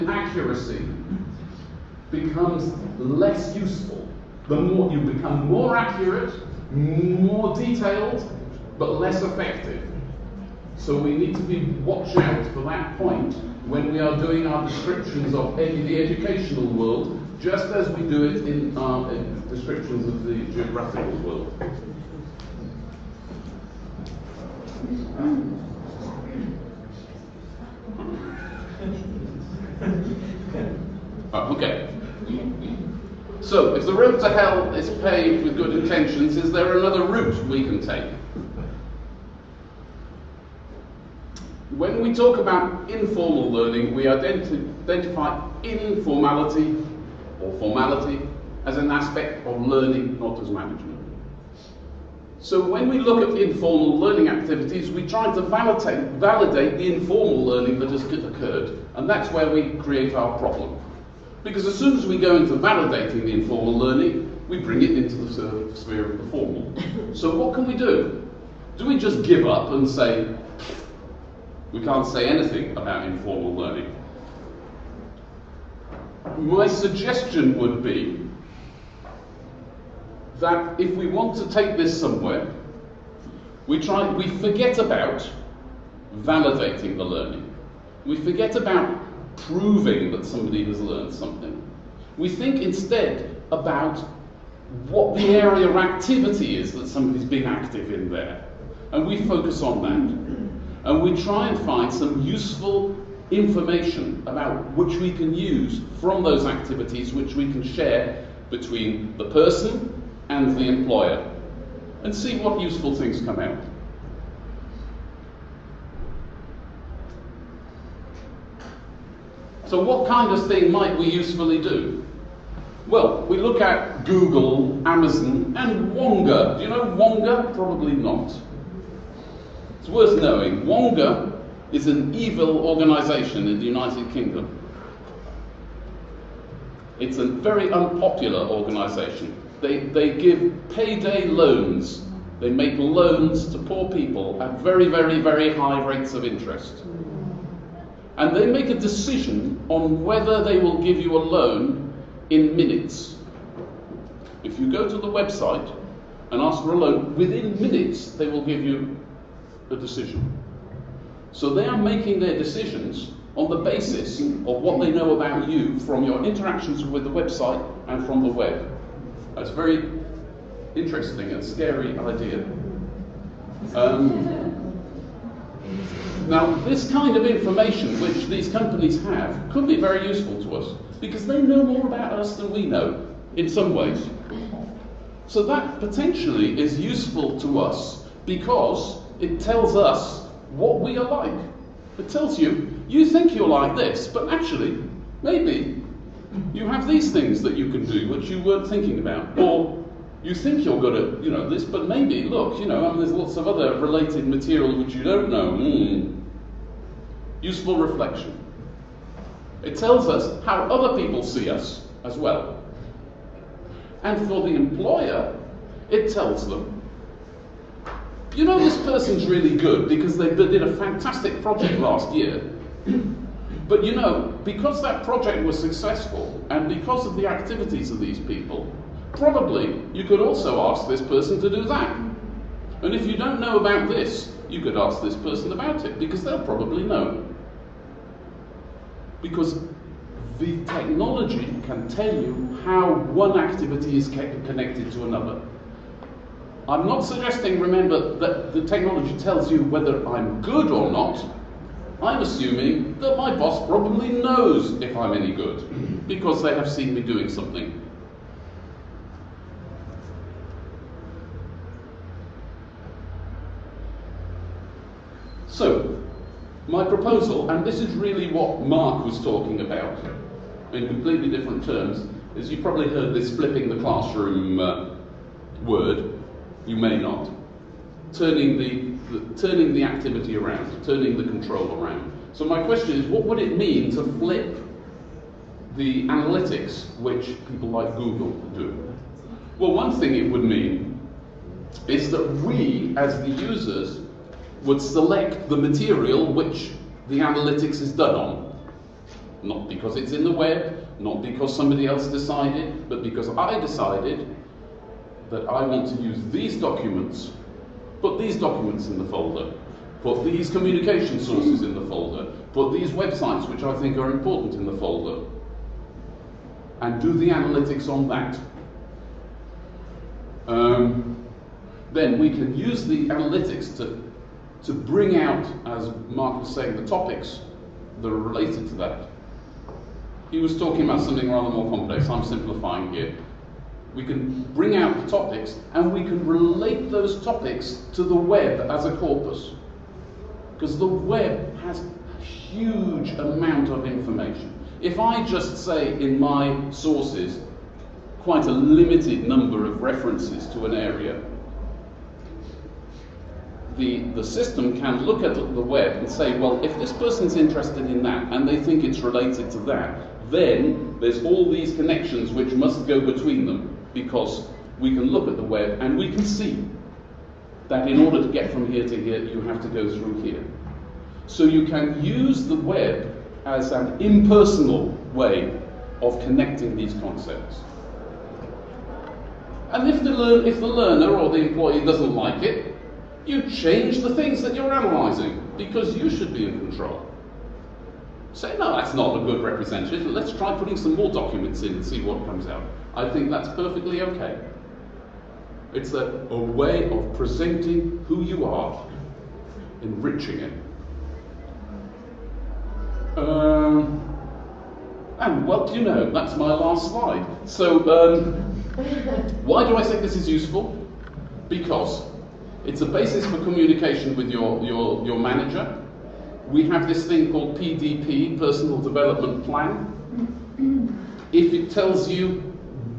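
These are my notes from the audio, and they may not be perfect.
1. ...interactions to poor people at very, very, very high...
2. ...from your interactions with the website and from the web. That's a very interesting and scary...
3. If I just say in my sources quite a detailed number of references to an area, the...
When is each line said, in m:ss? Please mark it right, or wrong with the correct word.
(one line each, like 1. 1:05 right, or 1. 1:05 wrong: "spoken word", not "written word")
1. 2:22 wrong: "loans", not "interactions"
2. 2:45 right
3. 5:44 wrong: "limited", not "detailed".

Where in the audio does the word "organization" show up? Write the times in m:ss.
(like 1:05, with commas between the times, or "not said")
2:12, 2:18.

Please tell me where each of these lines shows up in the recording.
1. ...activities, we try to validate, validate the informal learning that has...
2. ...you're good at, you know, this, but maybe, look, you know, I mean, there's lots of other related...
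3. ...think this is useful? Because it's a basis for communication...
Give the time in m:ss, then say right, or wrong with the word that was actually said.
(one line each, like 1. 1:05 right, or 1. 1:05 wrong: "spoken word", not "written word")
1. 0:54 right
2. 3:20 right
3. 6:49 right.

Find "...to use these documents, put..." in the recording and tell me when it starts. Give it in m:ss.
5:05.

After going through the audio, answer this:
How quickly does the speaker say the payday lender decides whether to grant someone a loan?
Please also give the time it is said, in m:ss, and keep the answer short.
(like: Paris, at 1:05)
In minutes, at 2:32.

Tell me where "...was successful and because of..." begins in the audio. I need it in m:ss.
3:45.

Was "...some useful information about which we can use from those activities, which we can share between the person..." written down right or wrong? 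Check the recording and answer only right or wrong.
right.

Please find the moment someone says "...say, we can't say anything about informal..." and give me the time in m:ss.
1:09.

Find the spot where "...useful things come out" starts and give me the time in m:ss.
1:52.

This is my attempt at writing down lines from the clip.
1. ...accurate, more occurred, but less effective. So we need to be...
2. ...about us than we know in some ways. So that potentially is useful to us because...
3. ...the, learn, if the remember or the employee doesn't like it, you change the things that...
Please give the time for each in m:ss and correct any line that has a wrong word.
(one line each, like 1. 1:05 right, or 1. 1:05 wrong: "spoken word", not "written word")
1. 0:05 wrong: "detailed", not "occurred"
2. 3:01 right
3. 6:20 wrong: "learner", not "remember".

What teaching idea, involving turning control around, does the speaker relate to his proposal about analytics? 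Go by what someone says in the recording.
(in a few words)
Flipping the classroom.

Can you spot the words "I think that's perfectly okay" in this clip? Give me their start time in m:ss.
6:32.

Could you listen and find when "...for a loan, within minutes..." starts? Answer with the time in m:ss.
2:36.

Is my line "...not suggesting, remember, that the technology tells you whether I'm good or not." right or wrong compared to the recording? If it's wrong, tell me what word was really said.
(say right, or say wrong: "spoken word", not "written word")
right.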